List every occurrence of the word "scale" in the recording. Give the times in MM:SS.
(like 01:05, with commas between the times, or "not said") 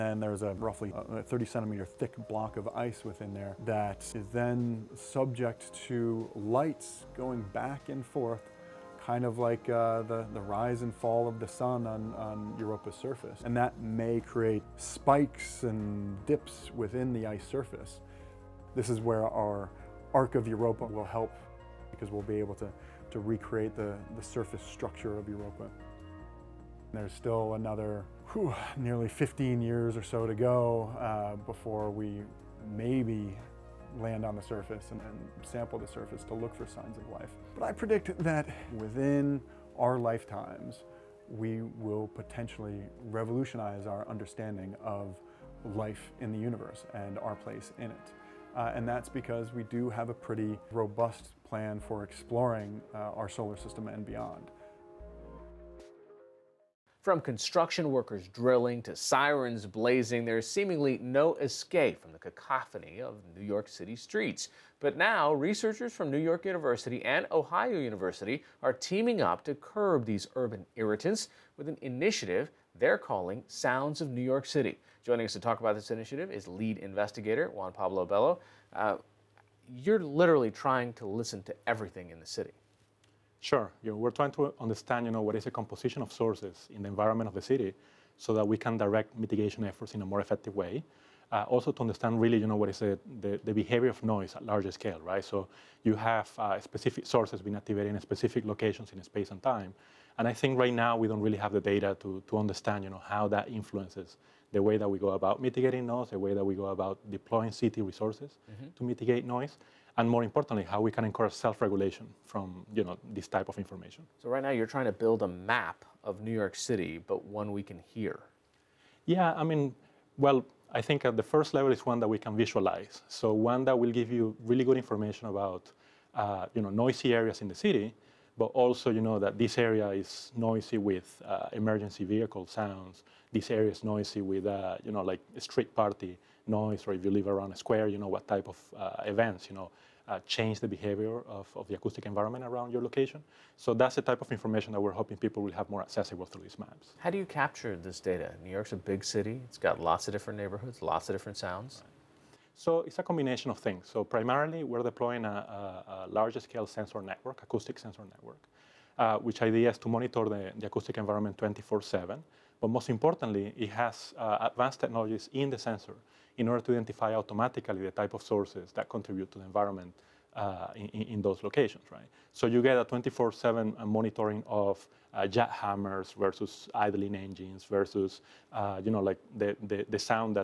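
01:34, 02:36.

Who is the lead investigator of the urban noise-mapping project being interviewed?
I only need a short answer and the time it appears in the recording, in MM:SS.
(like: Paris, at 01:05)
Juan Pablo Bello, at 01:17.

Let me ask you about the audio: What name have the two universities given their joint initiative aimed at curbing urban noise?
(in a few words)
Sounds of New York City.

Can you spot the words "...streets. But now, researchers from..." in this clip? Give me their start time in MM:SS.
01:03.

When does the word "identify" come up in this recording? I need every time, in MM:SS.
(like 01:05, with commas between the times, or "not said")
02:46.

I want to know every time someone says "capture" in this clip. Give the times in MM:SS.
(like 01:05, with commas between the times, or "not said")
02:27.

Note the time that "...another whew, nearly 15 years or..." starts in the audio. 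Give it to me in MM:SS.
00:27.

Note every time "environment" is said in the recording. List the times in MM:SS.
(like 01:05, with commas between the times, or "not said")
01:26, 02:22, 02:40, 02:49.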